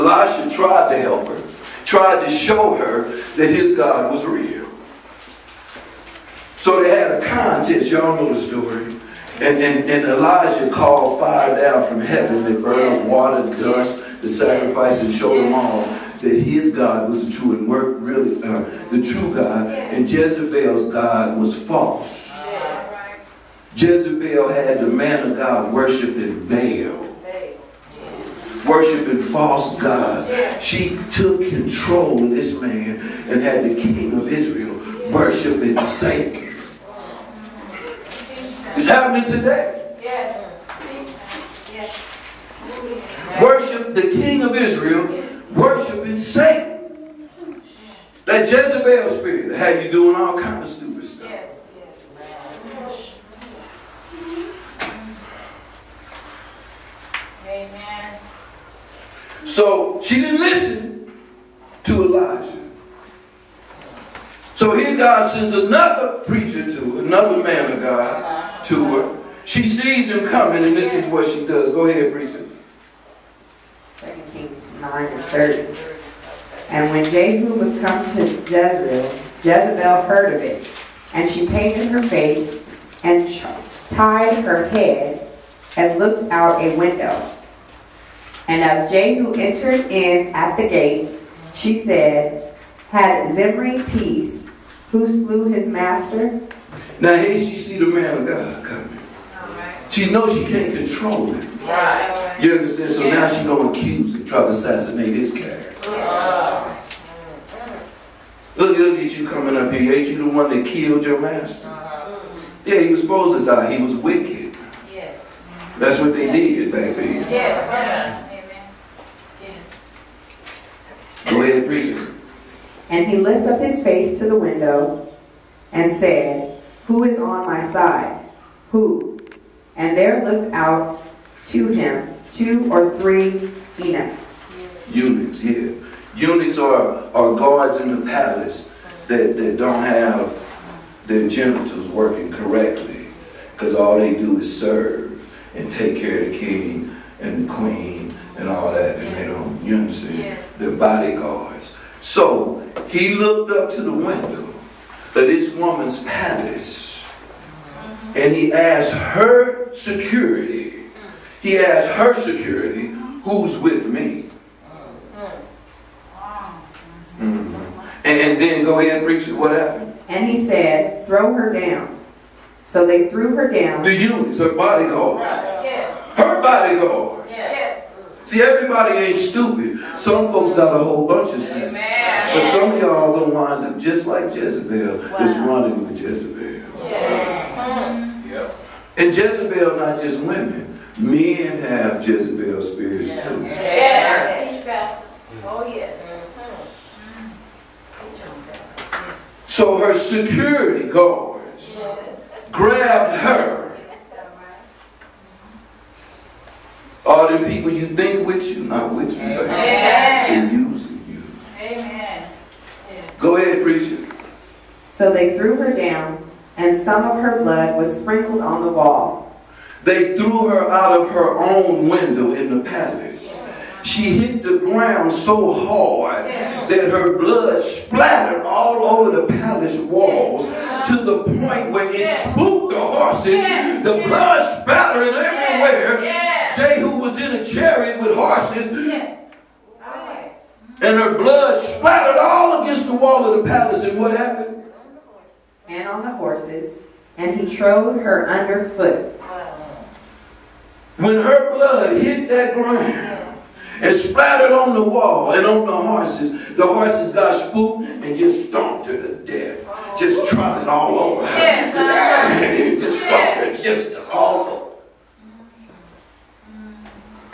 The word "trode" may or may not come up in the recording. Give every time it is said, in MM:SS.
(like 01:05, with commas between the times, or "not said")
04:07.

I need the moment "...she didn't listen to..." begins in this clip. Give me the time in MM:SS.
01:00.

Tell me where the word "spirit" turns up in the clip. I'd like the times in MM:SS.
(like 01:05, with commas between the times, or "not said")
00:49, 03:12.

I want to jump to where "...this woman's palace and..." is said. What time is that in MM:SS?
02:35.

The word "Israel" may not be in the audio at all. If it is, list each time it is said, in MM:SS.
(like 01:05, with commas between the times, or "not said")
00:34, 00:44.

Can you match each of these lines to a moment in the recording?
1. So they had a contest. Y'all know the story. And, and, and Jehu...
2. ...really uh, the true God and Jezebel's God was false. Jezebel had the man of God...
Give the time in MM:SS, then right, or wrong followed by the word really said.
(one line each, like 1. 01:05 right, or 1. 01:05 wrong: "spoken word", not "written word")
1. 00:06 wrong: "Elijah", not "Jehu"
2. 00:17 right.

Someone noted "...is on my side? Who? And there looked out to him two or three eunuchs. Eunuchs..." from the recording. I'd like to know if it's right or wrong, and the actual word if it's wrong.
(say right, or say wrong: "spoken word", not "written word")
right.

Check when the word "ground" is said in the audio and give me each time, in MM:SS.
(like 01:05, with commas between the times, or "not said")
03:44, 04:12.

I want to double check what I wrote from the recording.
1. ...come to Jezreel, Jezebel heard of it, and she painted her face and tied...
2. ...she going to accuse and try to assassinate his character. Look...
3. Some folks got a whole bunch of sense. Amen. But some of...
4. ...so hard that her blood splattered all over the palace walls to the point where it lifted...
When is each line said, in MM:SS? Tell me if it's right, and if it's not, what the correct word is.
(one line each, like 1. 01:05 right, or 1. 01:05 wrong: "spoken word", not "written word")
1. 01:17 right
2. 01:43 right
3. 02:59 right
4. 03:45 wrong: "spooked", not "lifted".